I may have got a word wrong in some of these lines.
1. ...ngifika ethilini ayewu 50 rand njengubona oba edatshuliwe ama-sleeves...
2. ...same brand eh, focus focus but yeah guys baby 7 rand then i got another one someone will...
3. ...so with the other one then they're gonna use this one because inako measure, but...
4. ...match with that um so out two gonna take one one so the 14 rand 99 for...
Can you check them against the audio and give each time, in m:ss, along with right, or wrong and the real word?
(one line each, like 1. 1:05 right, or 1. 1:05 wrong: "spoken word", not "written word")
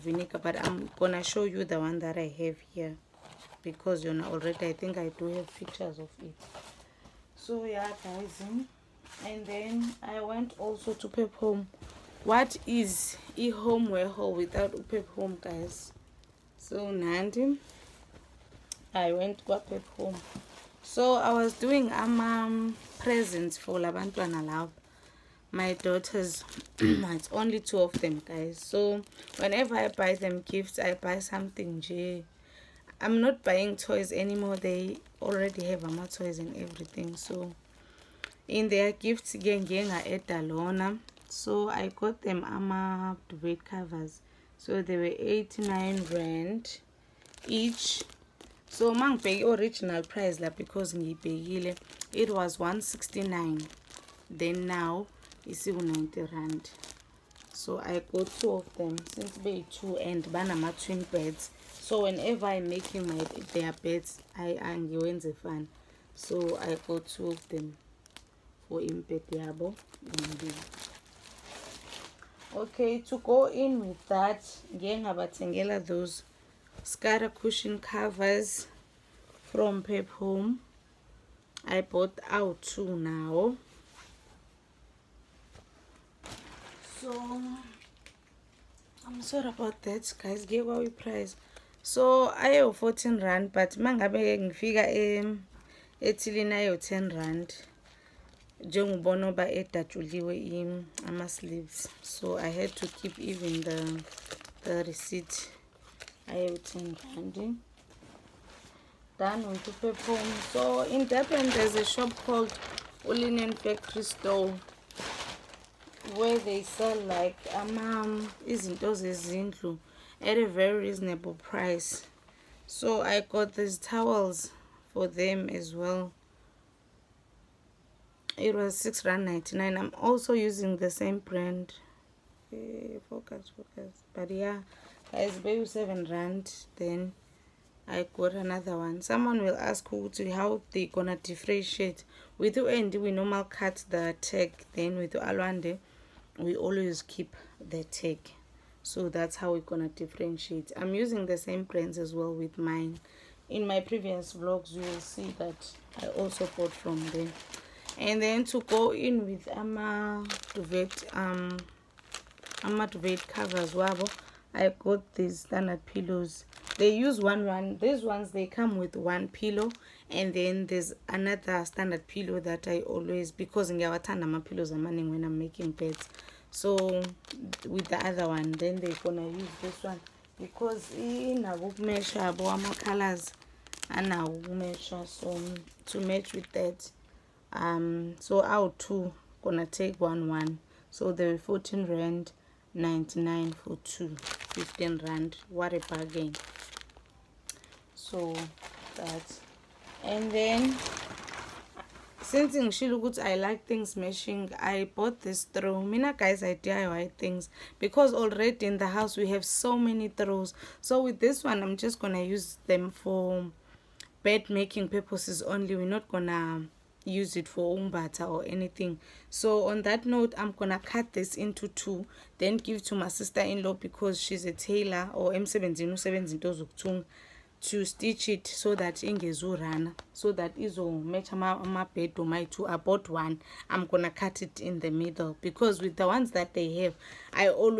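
1. 1:34 wrong: "10", not "50"
2. 2:10 right
3. 2:56 right
4. 3:06 right.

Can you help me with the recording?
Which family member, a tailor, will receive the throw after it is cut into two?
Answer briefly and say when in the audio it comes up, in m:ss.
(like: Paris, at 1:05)
sister-in-law, at 3:43.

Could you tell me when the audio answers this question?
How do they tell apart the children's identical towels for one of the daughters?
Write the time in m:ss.
2:27.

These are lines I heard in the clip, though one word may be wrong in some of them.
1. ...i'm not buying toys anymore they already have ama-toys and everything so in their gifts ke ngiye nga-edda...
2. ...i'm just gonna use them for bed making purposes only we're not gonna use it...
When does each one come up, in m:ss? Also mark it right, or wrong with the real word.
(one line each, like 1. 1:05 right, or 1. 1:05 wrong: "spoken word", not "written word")
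1. 0:33 right
2. 3:31 right.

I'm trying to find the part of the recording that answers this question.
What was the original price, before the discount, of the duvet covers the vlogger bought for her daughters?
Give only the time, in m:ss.
0:52.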